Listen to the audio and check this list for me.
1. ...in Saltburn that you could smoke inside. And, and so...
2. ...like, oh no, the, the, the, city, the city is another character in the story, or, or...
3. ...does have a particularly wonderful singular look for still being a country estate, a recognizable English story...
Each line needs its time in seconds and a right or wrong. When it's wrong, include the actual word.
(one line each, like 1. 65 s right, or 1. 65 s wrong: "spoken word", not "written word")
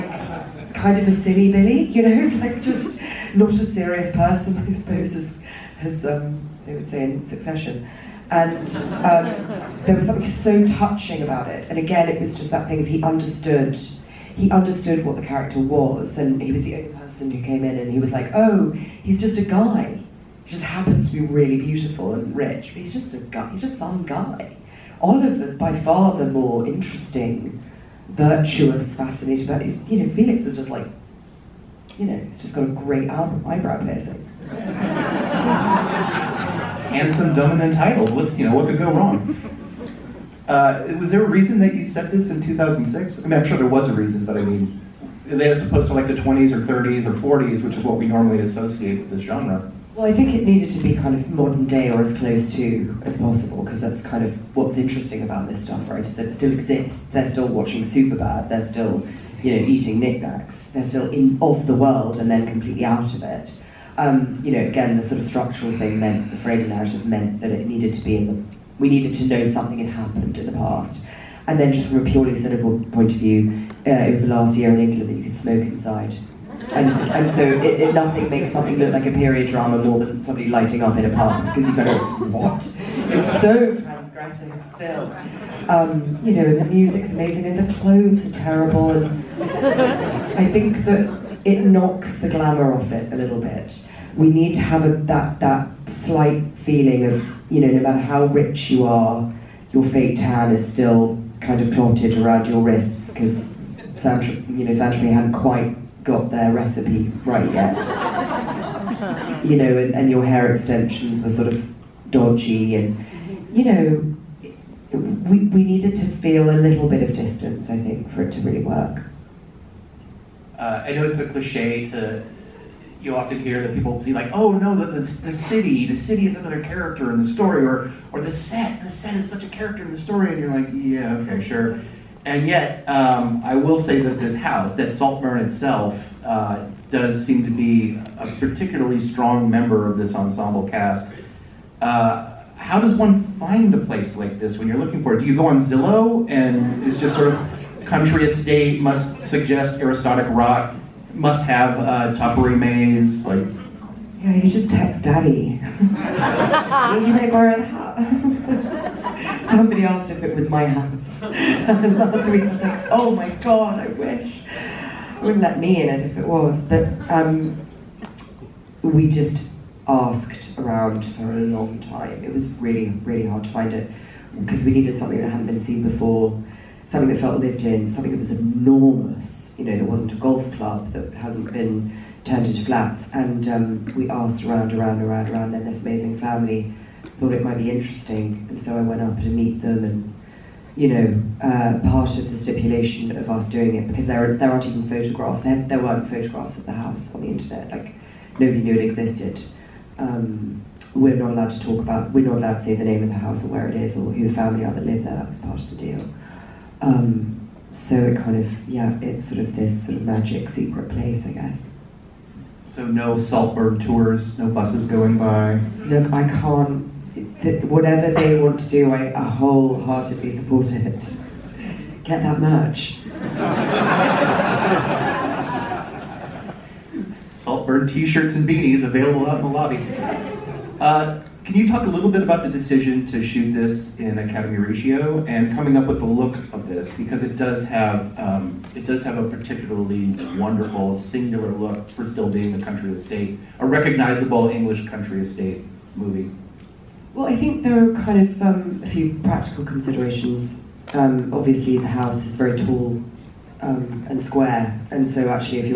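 1. 74 s wrong: "England", not "Saltburn"
2. 124 s right
3. 238 s wrong: "country", not "story".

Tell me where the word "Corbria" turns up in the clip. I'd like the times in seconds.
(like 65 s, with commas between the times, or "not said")
not said.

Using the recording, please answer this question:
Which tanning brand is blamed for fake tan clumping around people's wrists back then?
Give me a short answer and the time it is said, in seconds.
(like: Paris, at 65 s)
Saint Tropez, at 104 s.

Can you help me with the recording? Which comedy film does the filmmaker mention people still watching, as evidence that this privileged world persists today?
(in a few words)
Superbad.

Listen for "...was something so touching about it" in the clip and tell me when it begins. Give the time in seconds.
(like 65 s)
9 s.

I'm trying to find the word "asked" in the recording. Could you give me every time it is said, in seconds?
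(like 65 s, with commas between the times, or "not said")
159 s, 169 s, 184 s.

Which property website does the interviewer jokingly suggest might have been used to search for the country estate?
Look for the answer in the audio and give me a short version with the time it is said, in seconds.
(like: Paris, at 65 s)
Zillow, at 145 s.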